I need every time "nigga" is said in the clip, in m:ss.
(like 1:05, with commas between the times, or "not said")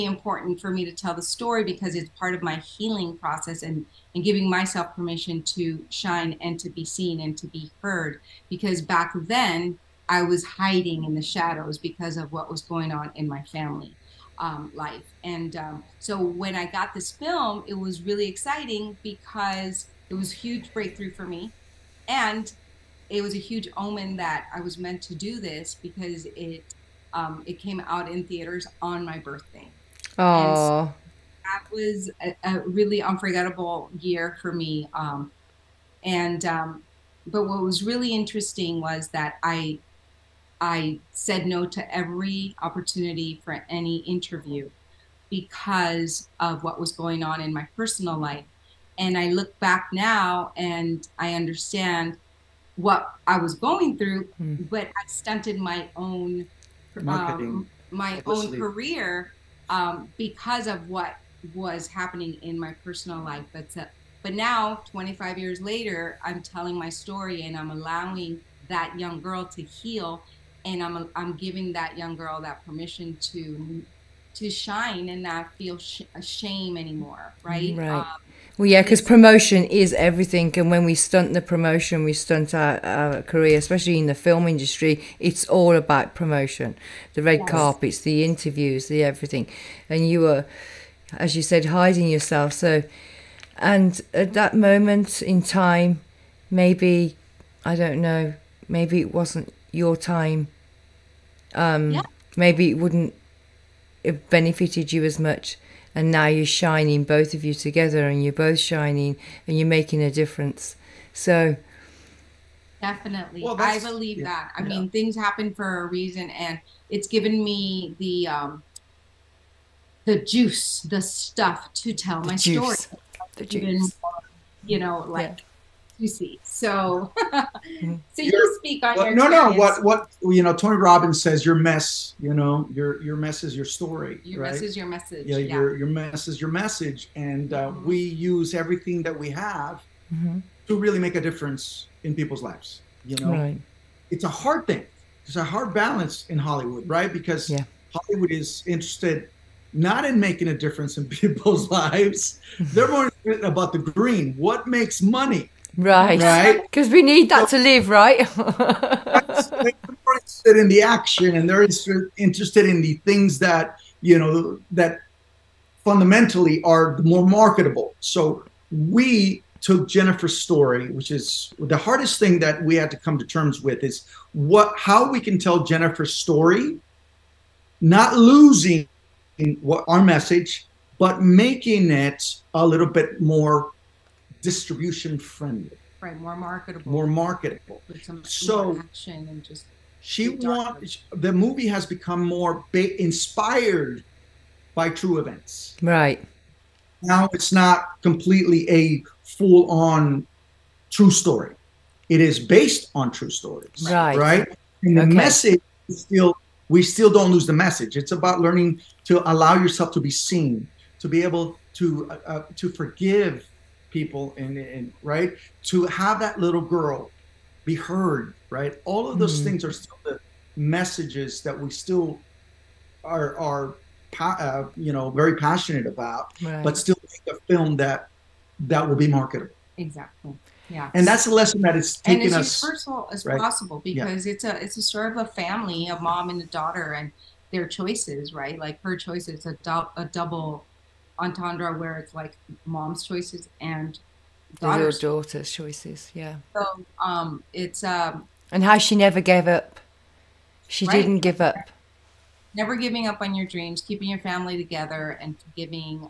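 not said.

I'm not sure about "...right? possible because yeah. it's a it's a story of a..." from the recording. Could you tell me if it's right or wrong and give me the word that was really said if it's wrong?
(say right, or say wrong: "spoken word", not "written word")
right.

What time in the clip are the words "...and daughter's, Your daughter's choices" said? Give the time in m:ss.
4:03.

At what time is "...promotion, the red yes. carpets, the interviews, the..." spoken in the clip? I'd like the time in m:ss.
1:26.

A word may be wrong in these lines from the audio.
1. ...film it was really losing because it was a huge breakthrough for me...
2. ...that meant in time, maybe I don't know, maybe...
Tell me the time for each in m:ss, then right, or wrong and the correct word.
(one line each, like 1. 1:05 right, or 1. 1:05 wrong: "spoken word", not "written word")
1. 0:17 wrong: "exciting", not "losing"
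2. 1:34 wrong: "moment", not "meant".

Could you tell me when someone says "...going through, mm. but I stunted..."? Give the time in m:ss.
0:53.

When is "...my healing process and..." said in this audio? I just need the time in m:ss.
0:02.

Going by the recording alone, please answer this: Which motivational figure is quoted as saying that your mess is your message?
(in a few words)
Tony Robbins.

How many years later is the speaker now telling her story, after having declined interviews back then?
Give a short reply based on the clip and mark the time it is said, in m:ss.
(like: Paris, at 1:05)
25, at 1:04.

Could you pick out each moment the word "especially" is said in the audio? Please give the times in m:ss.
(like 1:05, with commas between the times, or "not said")
1:23.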